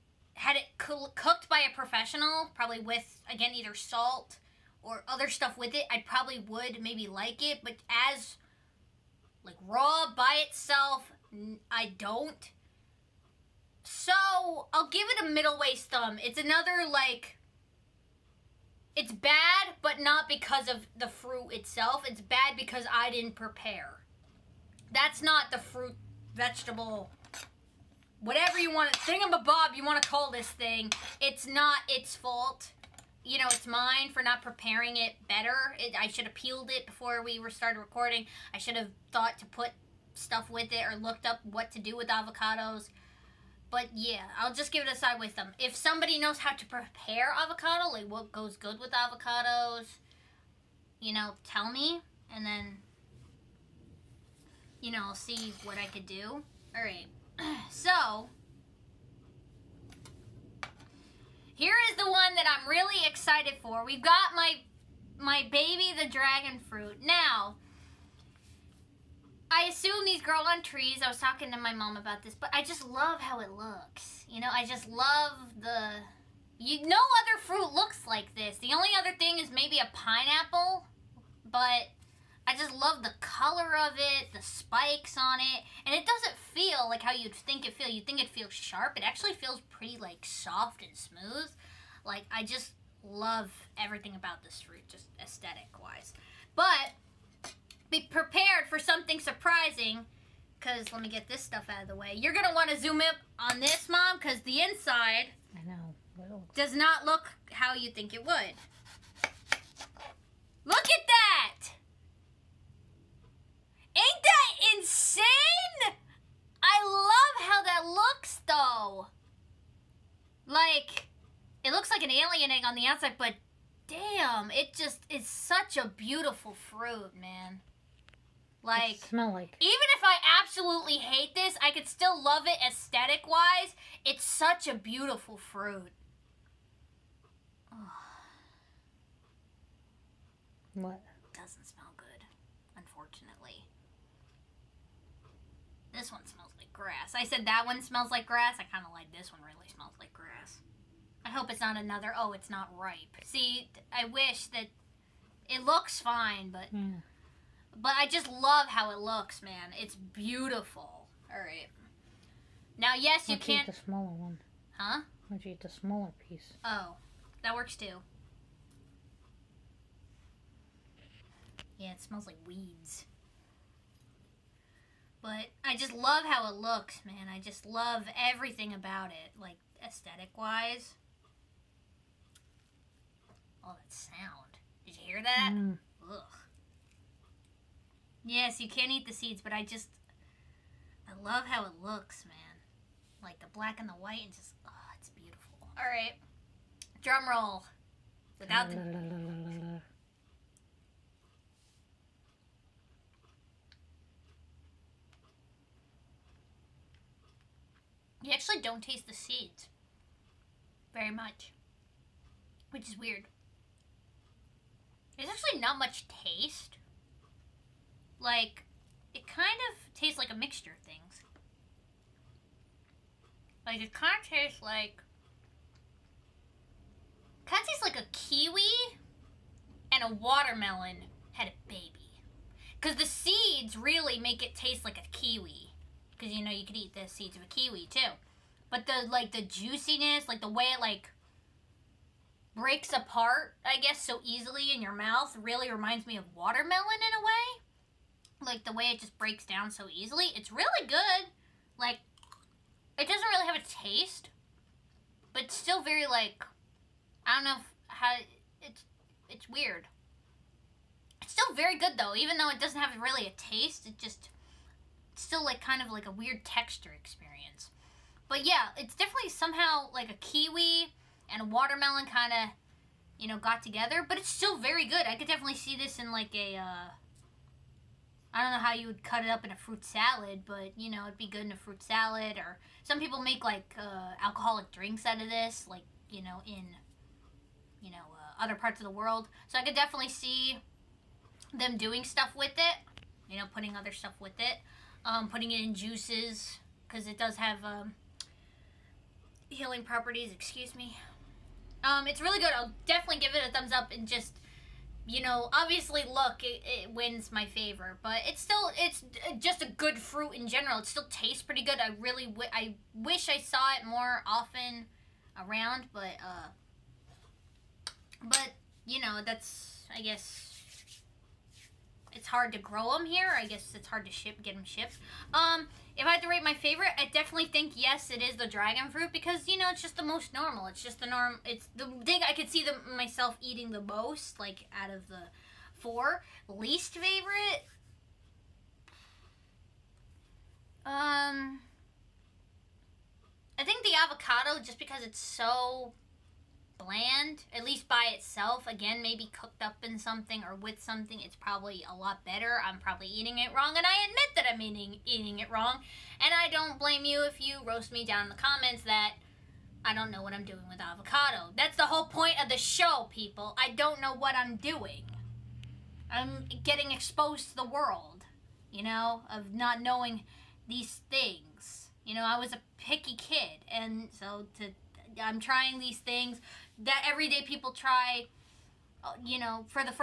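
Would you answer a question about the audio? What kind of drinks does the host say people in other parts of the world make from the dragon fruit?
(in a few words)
alcoholic drinks.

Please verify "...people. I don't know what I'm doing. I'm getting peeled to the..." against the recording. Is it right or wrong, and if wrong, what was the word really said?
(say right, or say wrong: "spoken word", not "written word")
wrong: "exposed", not "peeled".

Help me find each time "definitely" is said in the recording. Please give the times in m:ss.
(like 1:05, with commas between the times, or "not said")
4:28, 4:35, 4:49, 5:02, 5:27.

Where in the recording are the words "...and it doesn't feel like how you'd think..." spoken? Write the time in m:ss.
1:25.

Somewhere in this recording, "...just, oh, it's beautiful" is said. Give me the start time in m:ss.
3:14.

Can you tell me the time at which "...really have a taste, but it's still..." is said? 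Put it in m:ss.
4:13.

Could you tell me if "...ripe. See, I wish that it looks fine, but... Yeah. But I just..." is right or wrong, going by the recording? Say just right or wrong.
right.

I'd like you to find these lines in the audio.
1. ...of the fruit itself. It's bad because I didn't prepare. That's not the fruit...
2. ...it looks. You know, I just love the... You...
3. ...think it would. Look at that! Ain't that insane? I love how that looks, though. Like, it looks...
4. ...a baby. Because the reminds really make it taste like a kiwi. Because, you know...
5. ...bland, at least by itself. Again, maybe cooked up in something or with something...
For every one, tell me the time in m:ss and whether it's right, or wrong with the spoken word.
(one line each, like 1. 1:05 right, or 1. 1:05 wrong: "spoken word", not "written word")
1. 0:20 right
2. 1:13 right
3. 1:47 right
4. 3:51 wrong: "seeds", not "reminds"
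5. 5:46 right.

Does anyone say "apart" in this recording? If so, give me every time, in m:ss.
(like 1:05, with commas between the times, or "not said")
4:02.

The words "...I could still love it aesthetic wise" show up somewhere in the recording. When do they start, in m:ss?
2:11.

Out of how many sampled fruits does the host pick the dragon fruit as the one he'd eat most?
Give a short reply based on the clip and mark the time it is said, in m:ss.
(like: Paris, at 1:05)
4, at 5:35.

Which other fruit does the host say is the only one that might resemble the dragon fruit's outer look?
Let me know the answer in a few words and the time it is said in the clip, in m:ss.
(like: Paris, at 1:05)
pineapple, at 1:19.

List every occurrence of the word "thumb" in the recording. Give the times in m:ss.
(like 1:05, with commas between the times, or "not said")
0:15, 5:03.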